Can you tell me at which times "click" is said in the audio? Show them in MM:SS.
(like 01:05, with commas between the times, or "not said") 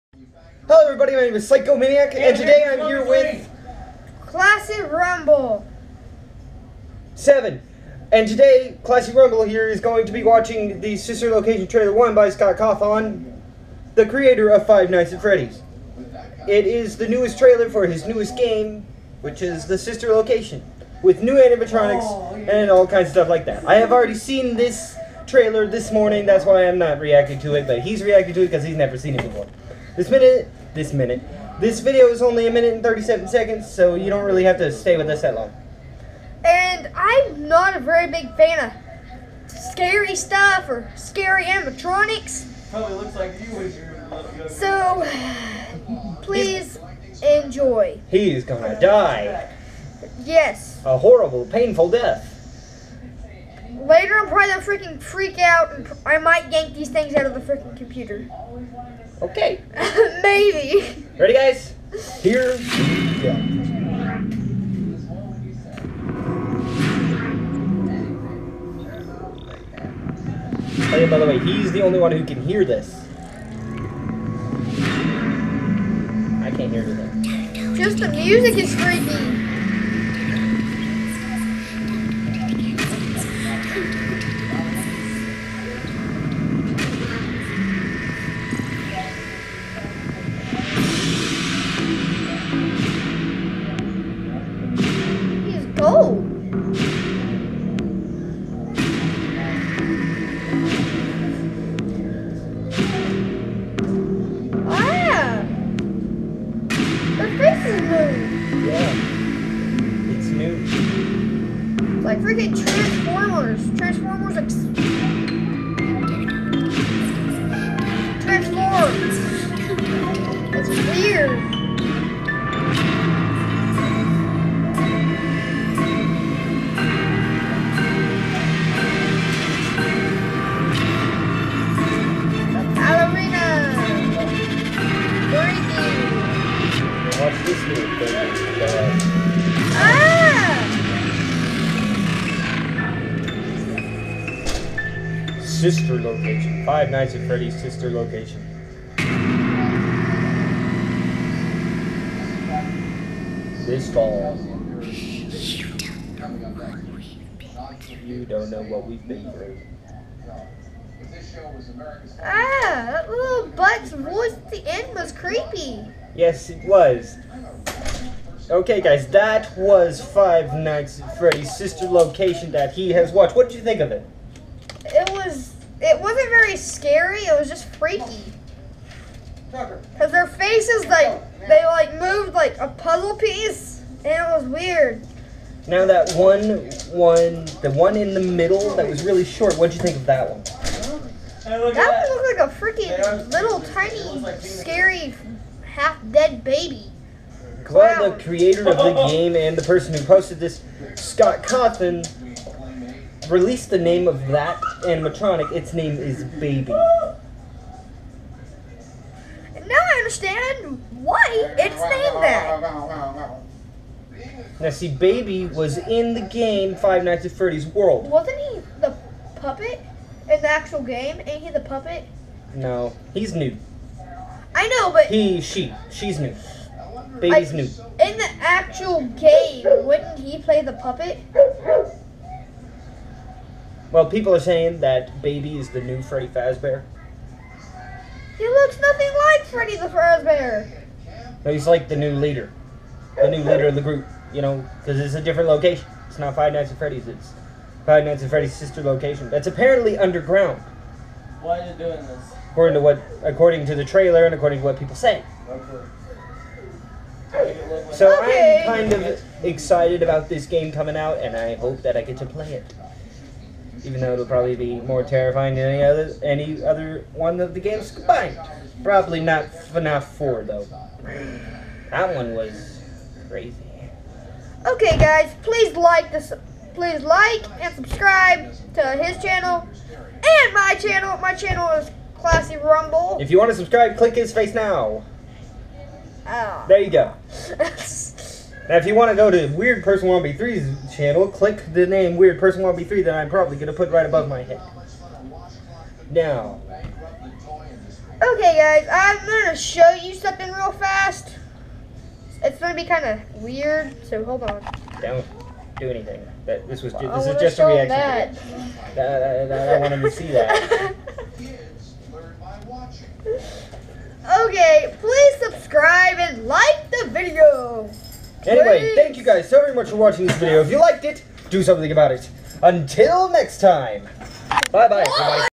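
04:43, 04:51.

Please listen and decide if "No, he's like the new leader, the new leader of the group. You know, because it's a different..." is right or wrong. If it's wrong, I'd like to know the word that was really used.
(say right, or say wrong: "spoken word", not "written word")
right.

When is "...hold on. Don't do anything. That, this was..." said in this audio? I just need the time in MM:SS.
05:04.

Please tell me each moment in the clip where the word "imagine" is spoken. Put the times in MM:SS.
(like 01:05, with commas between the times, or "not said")
not said.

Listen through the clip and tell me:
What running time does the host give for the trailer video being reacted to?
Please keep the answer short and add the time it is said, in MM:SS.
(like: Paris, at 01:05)
1 minute 37 seconds, at 00:32.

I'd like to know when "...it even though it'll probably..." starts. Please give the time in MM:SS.
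04:22.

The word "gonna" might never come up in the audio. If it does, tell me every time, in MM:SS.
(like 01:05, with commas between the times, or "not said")
00:48, 00:54.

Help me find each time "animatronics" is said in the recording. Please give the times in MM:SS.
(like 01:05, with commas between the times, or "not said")
00:21, 00:41, 03:24.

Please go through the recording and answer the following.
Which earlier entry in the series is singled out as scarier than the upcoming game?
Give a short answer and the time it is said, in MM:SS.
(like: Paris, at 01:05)
FNAF 4, at 04:29.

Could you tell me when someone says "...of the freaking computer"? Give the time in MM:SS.
00:57.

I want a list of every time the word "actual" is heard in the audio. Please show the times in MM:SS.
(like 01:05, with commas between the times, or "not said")
03:40, 03:48.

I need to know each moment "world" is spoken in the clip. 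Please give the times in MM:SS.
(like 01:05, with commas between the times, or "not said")
03:37.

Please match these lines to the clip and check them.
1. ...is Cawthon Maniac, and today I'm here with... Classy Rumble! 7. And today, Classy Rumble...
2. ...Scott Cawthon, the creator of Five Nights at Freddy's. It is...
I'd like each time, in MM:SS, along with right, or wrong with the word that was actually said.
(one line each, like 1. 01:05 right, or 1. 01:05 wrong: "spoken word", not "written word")
1. 00:01 wrong: "Psycho", not "Cawthon"
2. 00:12 right.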